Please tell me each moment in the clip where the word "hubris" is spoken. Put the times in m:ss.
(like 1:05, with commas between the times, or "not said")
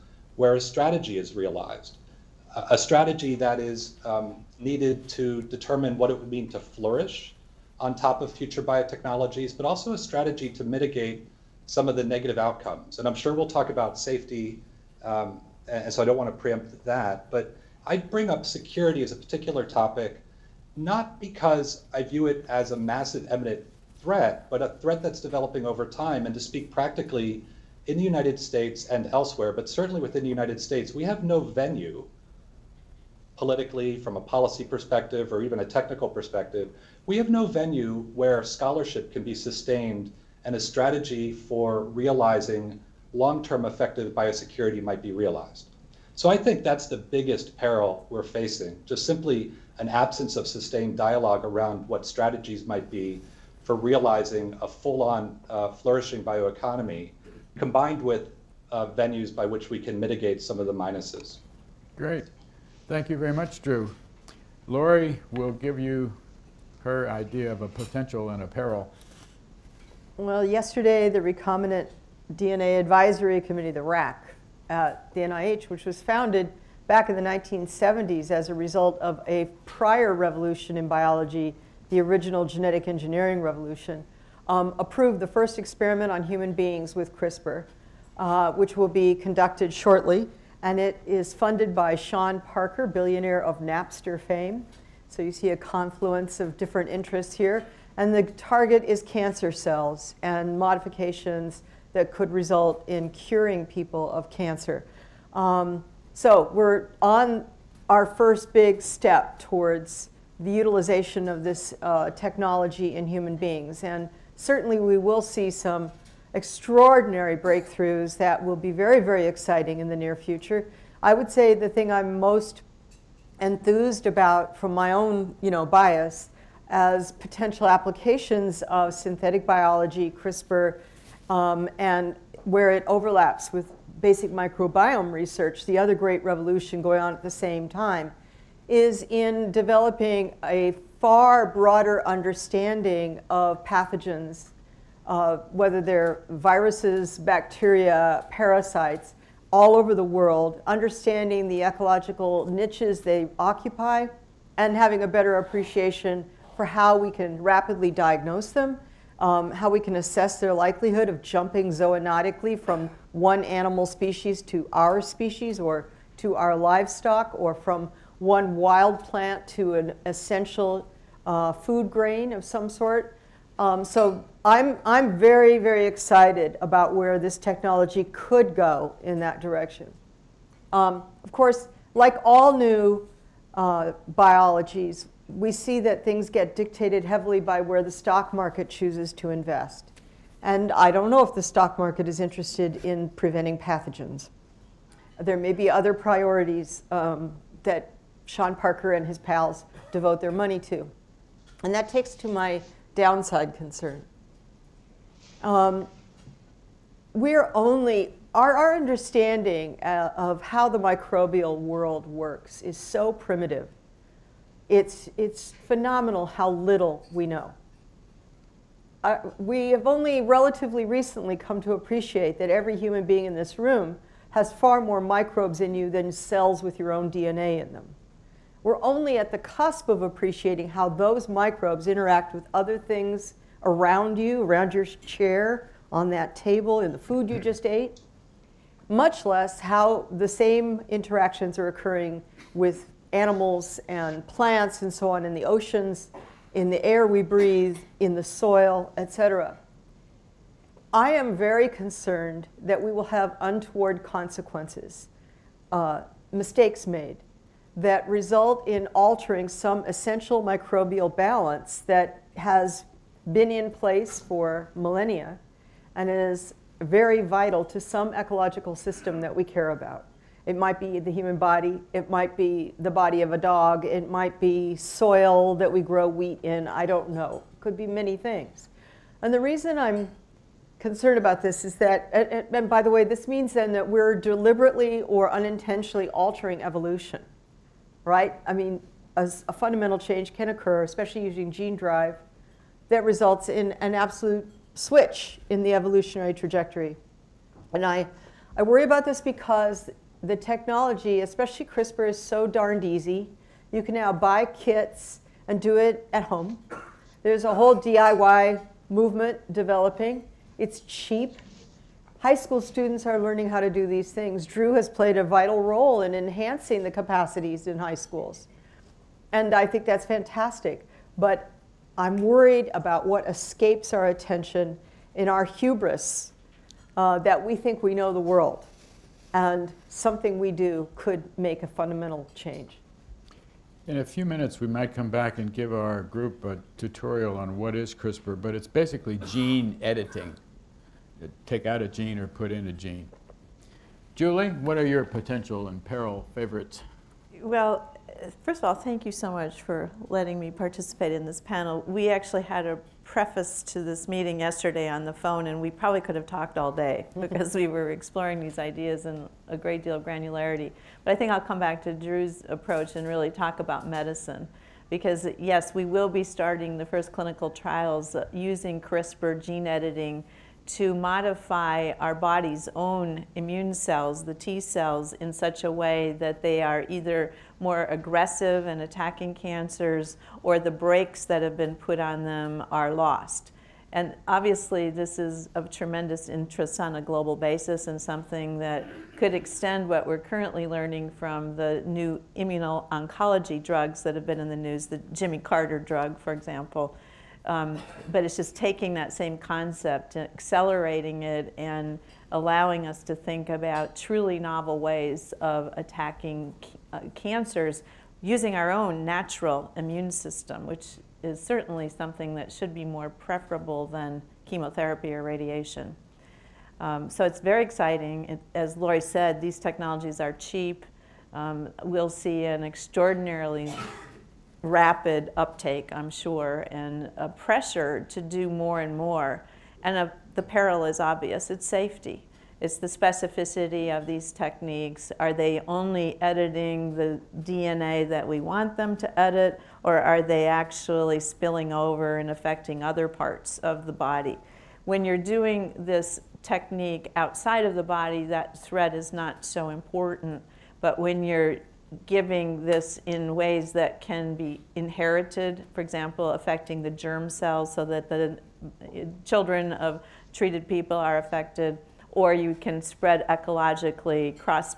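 5:25.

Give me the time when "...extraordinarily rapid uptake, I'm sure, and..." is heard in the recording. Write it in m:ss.
7:02.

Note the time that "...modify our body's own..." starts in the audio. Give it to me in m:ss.
6:10.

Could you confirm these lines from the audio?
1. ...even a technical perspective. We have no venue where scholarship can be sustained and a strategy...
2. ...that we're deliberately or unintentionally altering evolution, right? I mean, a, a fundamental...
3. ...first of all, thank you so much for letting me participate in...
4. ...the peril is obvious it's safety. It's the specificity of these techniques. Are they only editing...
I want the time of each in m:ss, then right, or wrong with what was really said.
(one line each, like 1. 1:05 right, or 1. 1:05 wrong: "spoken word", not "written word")
1. 0:35 right
2. 4:43 right
3. 5:48 right
4. 7:10 right.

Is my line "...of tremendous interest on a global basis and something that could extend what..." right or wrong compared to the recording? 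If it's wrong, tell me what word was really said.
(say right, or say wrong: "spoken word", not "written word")
right.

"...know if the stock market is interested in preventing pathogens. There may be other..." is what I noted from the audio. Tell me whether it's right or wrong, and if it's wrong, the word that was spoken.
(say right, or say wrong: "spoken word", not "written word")
right.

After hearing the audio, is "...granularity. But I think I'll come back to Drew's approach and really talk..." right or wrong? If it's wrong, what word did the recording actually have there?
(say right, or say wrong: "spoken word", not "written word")
right.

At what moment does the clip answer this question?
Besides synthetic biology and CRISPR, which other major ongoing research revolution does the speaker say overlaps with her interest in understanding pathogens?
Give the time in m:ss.
2:14.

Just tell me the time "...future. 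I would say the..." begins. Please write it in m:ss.
2:00.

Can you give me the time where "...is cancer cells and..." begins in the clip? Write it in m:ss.
1:38.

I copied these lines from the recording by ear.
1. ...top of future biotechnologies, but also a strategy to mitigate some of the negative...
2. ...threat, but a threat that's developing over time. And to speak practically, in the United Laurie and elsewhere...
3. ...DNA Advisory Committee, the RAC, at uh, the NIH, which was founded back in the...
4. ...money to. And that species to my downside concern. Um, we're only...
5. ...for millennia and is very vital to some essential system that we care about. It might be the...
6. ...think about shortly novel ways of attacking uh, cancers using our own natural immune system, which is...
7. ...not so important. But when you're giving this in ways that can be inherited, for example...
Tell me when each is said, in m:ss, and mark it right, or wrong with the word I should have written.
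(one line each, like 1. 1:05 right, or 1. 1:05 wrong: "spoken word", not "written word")
1. 0:07 right
2. 0:23 wrong: "States", not "Laurie"
3. 1:12 right
4. 3:20 wrong: "takes", not "species"
5. 4:24 wrong: "ecological", not "essential"
6. 6:43 wrong: "truly", not "shortly"
7. 7:29 right.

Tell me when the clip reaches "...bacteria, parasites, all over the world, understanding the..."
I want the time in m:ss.
2:27.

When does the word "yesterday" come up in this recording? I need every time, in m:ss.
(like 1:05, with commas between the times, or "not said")
1:10, 5:54.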